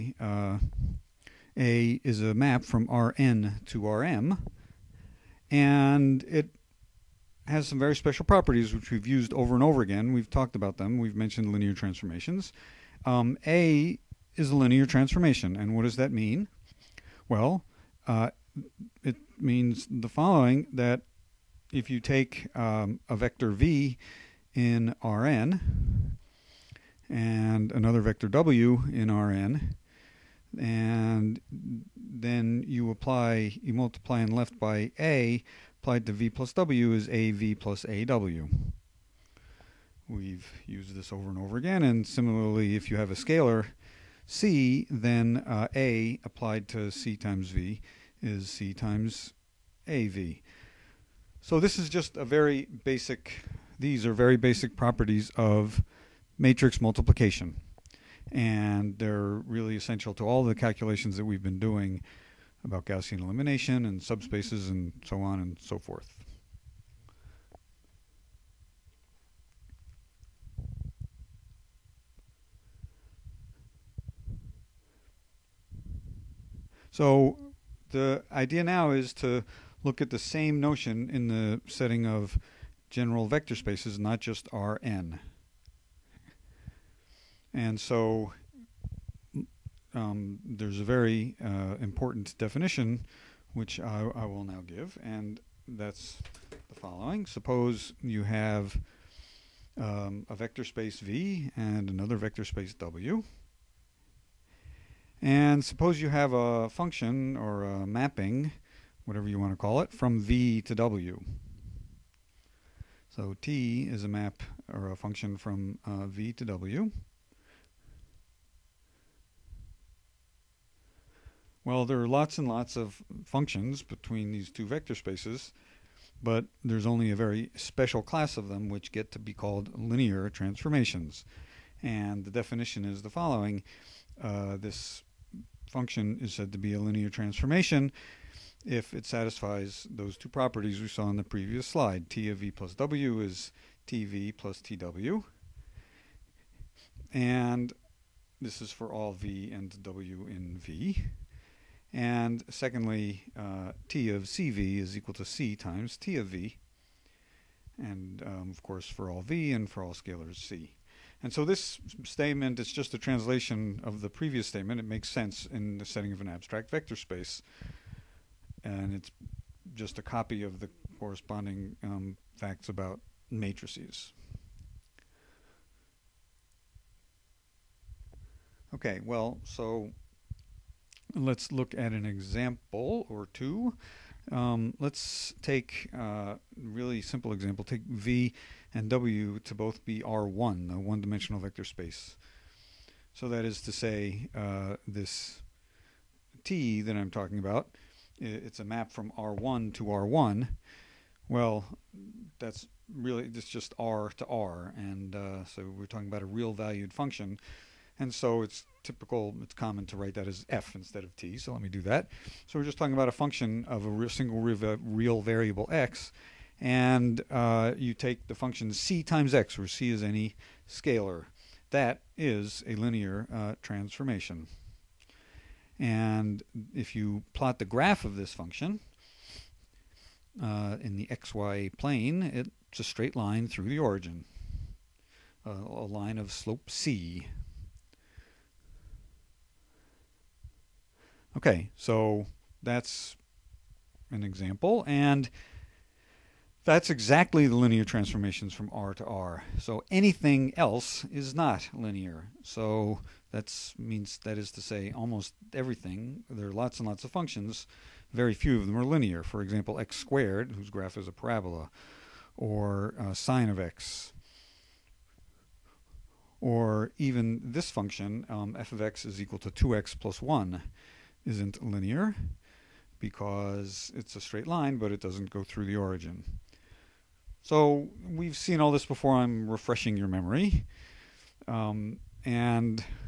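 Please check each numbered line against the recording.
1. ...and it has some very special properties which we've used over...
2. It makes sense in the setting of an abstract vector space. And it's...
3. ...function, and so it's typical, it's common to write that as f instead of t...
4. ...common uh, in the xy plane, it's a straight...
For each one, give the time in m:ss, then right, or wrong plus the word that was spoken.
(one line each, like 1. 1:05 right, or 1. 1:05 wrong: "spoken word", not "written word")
1. 0:05 right
2. 2:44 right
3. 3:26 right
4. 3:48 wrong: "function", not "common".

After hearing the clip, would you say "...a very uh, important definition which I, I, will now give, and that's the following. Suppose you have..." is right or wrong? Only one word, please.
right.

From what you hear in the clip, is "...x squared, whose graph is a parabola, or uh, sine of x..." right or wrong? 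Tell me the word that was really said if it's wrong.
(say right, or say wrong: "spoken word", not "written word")
right.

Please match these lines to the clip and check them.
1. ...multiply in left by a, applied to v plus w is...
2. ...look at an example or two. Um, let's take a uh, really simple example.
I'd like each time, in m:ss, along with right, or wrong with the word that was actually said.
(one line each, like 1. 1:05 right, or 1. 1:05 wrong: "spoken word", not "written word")
1. 0:33 right
2. 3:01 right.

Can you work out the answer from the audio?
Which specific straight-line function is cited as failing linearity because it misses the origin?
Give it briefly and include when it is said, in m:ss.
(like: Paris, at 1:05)
2x + 1, at 4:29.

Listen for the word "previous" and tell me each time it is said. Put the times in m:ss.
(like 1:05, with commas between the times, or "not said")
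2:21, 2:44.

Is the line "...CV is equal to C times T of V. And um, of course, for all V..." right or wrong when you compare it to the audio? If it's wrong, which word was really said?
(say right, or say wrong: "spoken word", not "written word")
right.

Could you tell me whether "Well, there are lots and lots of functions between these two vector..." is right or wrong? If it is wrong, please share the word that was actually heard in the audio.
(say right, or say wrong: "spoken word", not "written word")
right.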